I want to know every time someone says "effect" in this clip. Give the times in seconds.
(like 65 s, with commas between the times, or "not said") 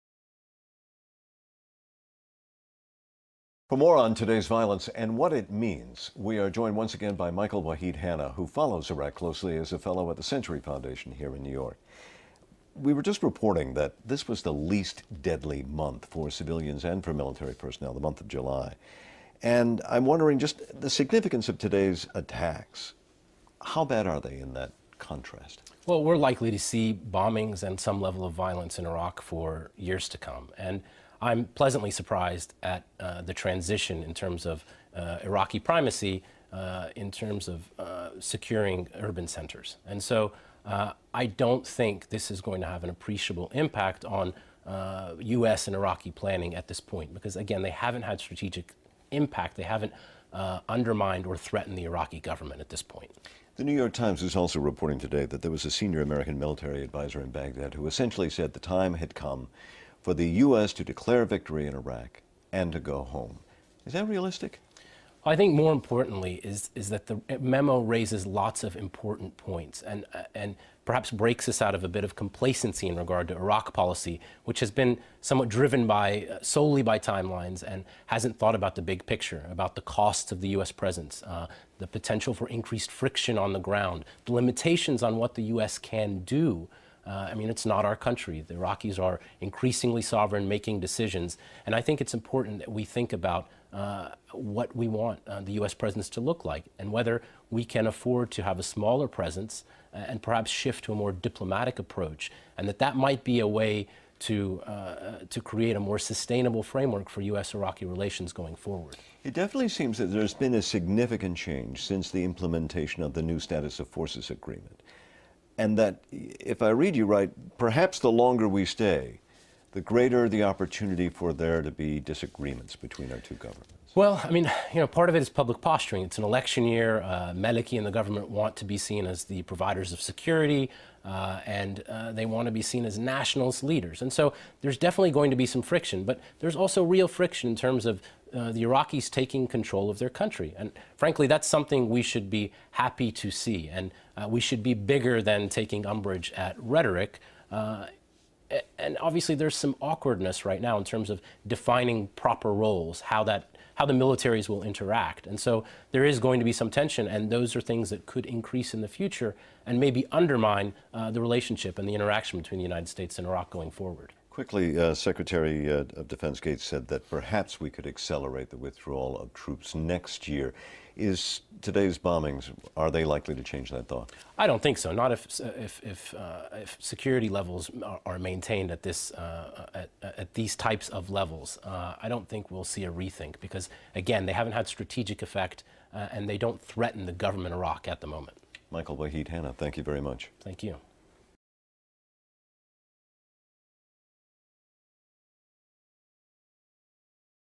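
185 s.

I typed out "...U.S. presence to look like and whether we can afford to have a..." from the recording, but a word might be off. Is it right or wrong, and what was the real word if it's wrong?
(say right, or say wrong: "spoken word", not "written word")
right.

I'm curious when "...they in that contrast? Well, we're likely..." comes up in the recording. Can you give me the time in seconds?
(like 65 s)
24 s.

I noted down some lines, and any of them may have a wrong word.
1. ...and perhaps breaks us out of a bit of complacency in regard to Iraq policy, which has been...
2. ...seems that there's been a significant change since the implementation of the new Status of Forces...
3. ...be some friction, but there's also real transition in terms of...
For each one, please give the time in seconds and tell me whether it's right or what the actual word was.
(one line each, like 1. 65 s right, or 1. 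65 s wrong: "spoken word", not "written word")
1. 70 s right
2. 109 s right
3. 135 s wrong: "friction", not "transition".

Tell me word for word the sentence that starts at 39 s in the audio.
And so uh, I don't think this is going to have an appreciable impact on U.S.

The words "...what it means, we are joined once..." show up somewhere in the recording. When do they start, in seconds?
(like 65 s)
5 s.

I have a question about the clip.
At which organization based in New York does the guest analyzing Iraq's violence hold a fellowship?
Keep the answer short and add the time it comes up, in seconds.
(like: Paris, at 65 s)
Century Foundation, at 10 s.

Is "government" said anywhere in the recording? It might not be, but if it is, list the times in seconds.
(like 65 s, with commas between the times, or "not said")
52 s, 123 s, 127 s, 187 s.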